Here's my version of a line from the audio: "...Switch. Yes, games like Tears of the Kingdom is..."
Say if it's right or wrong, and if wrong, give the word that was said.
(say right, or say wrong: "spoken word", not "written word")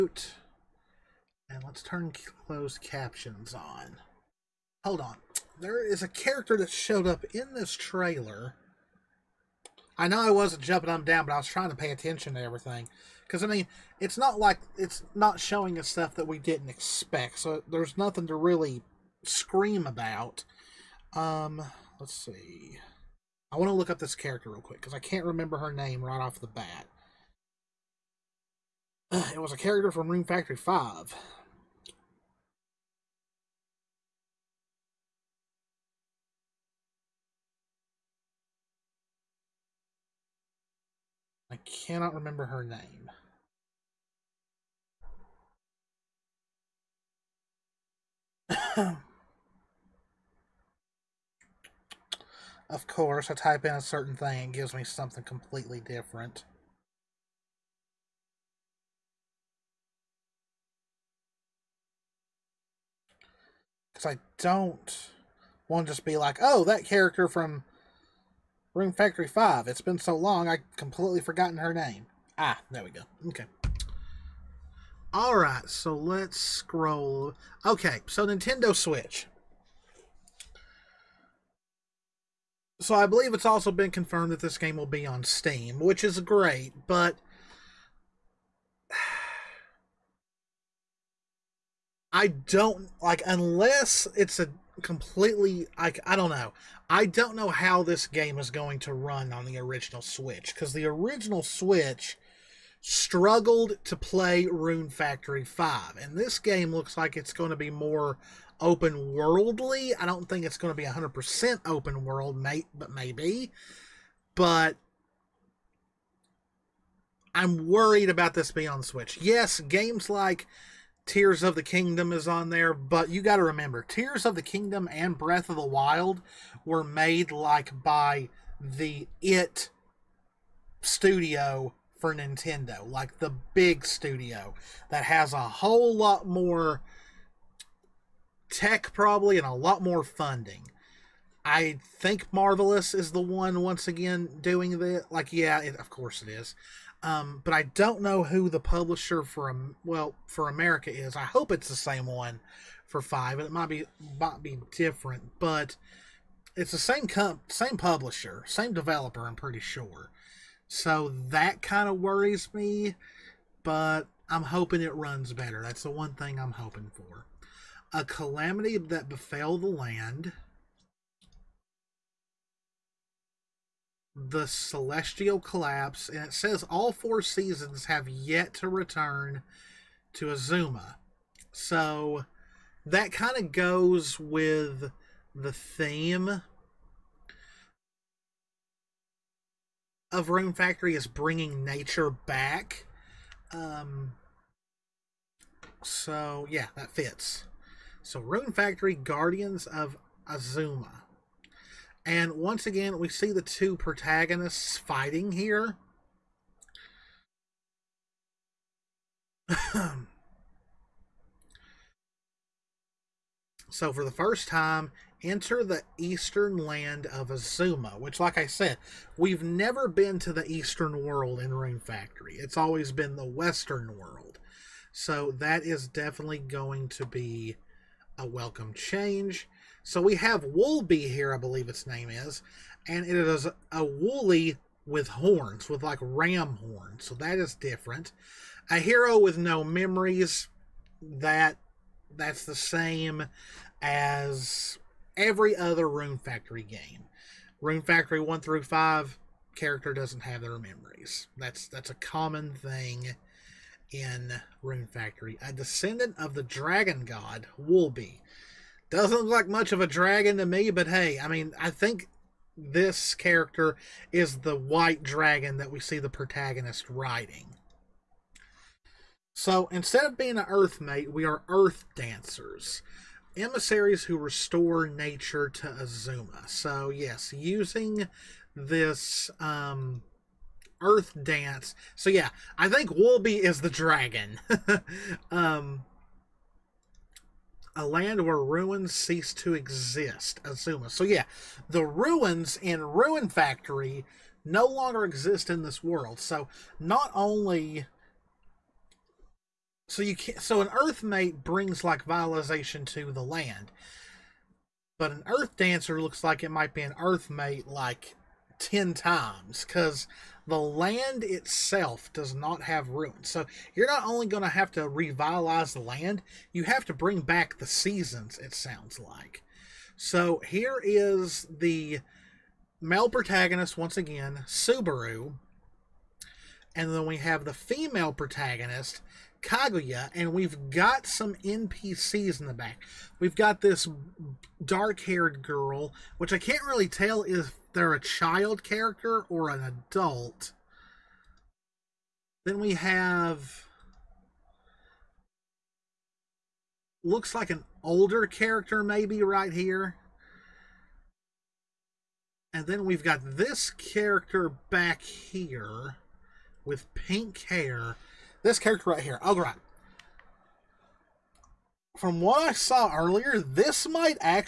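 right.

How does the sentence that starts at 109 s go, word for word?
I don't think it's going to be 100% open world, mate, but maybe.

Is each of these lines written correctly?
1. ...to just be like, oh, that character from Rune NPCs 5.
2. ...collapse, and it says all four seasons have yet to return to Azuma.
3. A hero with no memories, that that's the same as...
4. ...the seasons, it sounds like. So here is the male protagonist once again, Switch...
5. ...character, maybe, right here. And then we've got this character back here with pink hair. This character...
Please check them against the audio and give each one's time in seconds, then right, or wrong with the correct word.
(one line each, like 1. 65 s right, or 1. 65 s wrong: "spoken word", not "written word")
1. 65 s wrong: "Factory", not "NPCs"
2. 175 s right
3. 238 s right
4. 317 s wrong: "Subaru", not "Switch"
5. 348 s right.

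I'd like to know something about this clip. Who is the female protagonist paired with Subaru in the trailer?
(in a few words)
Kaguya.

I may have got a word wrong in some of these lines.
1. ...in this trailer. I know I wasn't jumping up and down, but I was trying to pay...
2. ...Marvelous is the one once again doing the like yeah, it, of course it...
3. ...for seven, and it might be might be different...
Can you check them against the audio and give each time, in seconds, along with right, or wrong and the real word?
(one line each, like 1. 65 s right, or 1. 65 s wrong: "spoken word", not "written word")
1. 7 s right
2. 142 s right
3. 152 s wrong: "five", not "seven".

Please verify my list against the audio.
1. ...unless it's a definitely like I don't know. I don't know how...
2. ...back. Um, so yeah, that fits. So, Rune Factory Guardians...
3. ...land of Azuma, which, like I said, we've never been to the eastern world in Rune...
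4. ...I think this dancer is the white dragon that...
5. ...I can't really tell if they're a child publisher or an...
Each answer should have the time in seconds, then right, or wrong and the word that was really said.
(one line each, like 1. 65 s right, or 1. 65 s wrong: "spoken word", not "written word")
1. 93 s wrong: "completely", not "definitely"
2. 192 s right
3. 216 s right
4. 261 s wrong: "character", not "dancer"
5. 336 s wrong: "character", not "publisher".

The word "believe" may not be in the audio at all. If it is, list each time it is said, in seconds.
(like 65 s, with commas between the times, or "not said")
83 s, 231 s.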